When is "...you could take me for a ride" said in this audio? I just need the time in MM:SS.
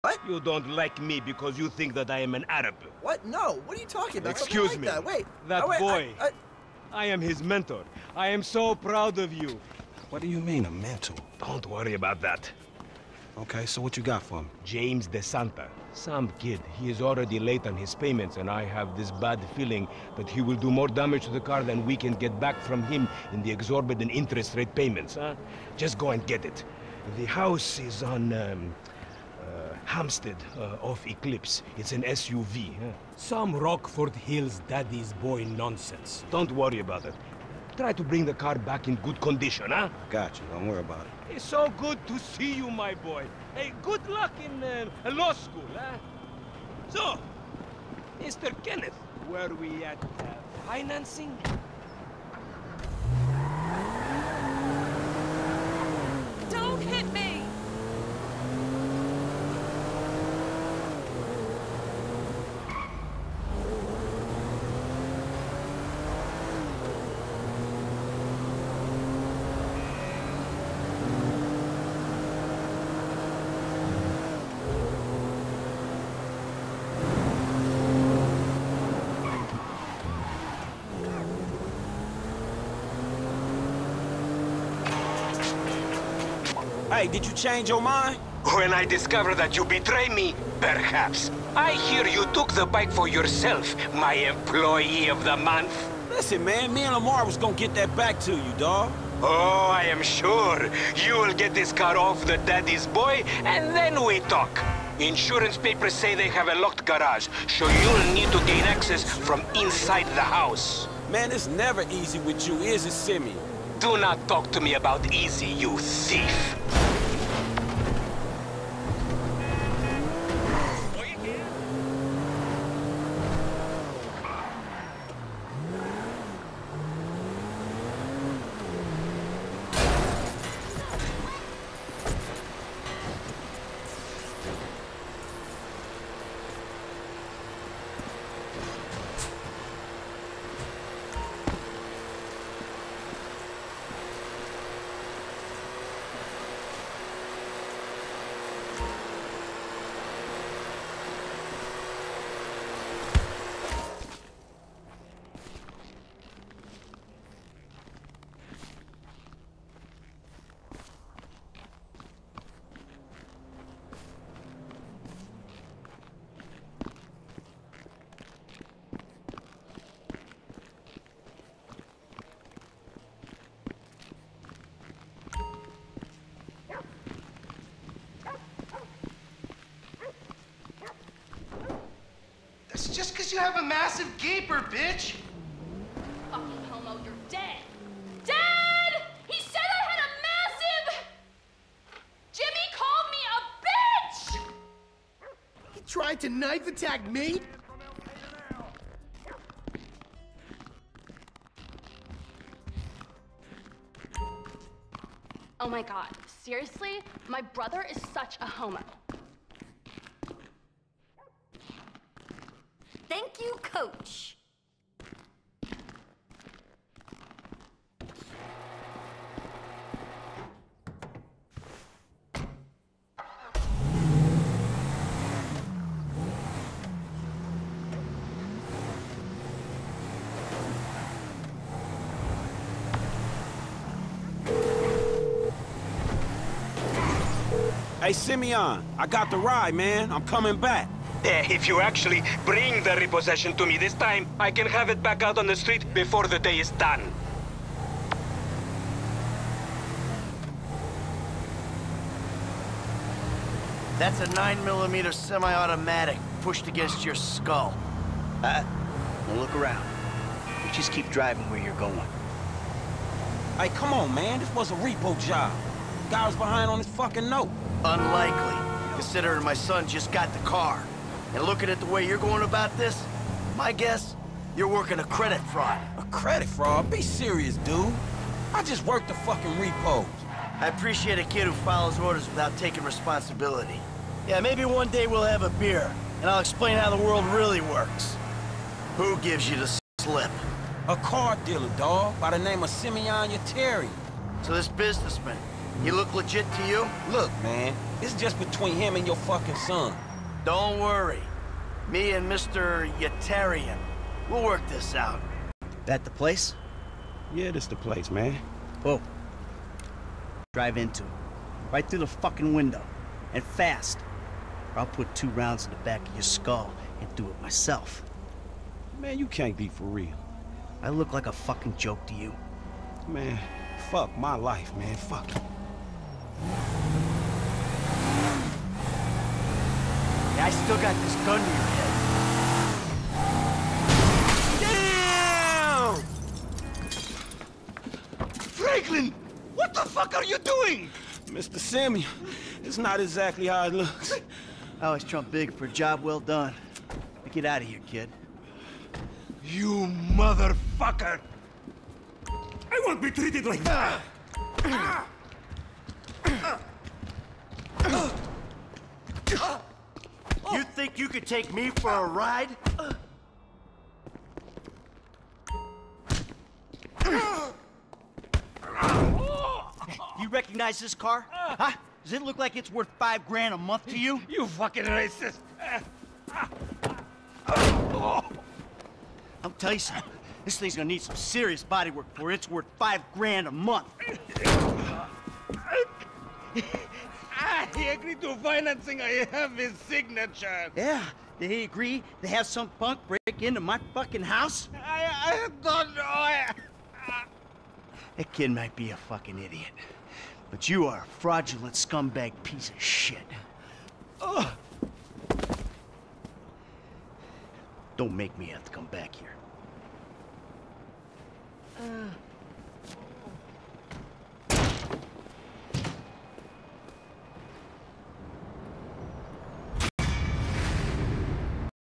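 06:00.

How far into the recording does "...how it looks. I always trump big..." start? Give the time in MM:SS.
05:43.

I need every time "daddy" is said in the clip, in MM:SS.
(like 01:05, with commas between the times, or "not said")
00:34, 01:42.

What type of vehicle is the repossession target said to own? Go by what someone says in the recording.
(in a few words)
SUV.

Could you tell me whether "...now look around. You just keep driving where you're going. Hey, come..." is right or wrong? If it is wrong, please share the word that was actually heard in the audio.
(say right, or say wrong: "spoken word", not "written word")
right.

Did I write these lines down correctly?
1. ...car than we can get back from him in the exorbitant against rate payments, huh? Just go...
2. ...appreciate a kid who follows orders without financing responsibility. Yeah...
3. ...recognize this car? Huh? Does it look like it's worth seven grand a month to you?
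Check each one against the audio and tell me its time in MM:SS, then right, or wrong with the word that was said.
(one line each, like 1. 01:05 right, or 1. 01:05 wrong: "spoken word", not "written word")
1. 00:21 wrong: "interest", not "against"
2. 04:40 wrong: "taking", not "financing"
3. 06:10 wrong: "five", not "seven".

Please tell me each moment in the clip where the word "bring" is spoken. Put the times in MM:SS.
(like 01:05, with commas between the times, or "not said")
00:38, 04:02.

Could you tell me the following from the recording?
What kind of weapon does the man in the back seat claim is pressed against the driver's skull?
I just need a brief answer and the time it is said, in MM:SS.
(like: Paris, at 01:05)
9mm semi-automatic, at 04:14.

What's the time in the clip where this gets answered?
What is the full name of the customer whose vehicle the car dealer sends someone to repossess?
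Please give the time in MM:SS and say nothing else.
00:14.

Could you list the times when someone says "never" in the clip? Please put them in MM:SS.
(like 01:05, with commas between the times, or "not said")
01:51.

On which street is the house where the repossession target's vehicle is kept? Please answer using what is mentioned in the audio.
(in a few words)
Hampstead.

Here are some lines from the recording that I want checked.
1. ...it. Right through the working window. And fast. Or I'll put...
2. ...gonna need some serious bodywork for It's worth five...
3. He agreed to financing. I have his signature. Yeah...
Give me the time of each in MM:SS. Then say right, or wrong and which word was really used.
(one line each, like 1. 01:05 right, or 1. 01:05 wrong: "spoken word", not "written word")
1. 05:11 wrong: "fucking", not "working"
2. 06:20 right
3. 06:27 right.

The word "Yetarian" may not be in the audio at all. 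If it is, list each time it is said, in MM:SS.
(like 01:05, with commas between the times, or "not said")
04:53, 05:02.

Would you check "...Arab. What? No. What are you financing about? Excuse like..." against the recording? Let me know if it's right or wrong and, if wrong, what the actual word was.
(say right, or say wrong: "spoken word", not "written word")
wrong: "talking", not "financing".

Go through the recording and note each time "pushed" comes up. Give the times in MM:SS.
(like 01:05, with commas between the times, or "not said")
04:16.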